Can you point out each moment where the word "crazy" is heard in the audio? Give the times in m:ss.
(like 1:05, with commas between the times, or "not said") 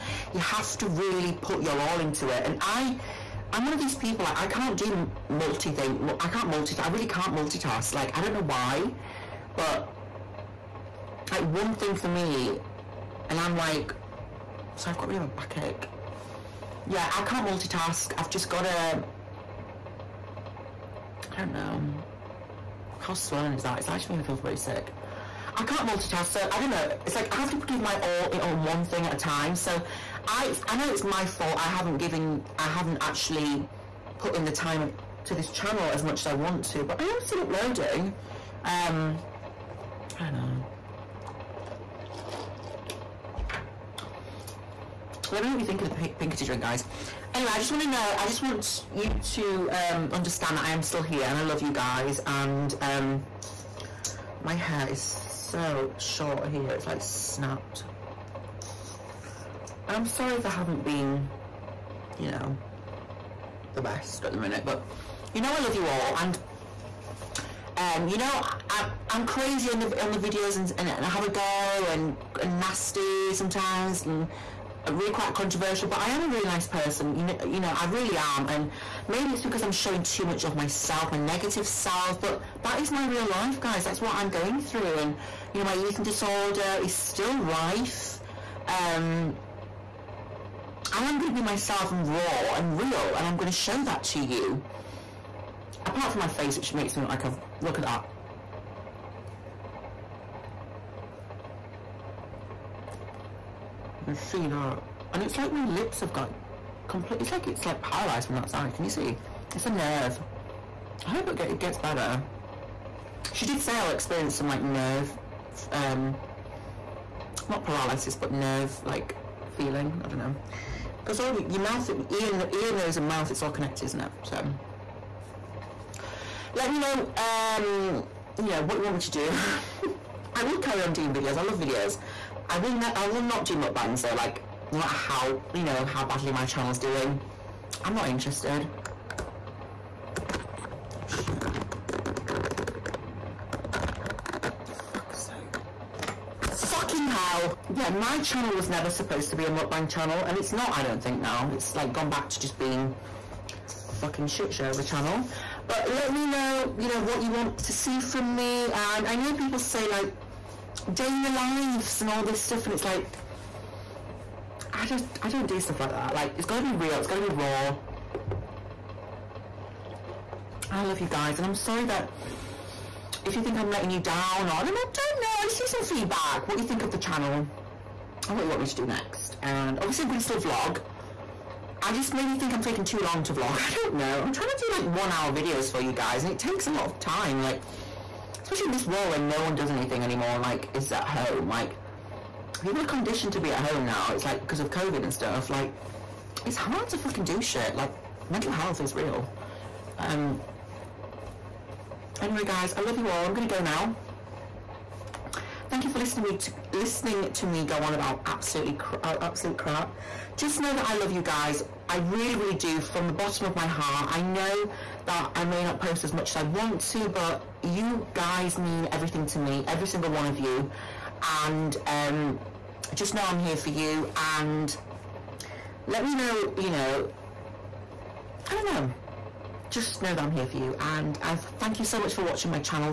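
1:09.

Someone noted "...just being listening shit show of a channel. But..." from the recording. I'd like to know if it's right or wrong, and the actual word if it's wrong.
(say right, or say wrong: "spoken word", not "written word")
wrong: "fucking", not "listening".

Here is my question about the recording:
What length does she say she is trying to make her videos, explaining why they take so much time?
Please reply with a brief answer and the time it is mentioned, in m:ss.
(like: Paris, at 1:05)
1 hour, at 3:04.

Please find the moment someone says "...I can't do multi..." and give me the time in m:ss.
0:04.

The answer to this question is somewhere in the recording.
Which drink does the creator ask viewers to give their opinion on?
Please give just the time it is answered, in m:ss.
0:46.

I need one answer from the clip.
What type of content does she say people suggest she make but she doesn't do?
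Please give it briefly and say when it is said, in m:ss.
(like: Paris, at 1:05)
Dana lives, at 2:40.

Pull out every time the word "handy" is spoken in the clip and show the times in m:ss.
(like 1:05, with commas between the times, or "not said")
not said.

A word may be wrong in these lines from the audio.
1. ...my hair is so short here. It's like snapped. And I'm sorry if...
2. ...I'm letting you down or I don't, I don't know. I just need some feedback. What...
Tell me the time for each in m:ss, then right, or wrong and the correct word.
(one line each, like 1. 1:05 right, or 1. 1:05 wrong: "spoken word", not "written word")
1. 0:54 right
2. 2:53 right.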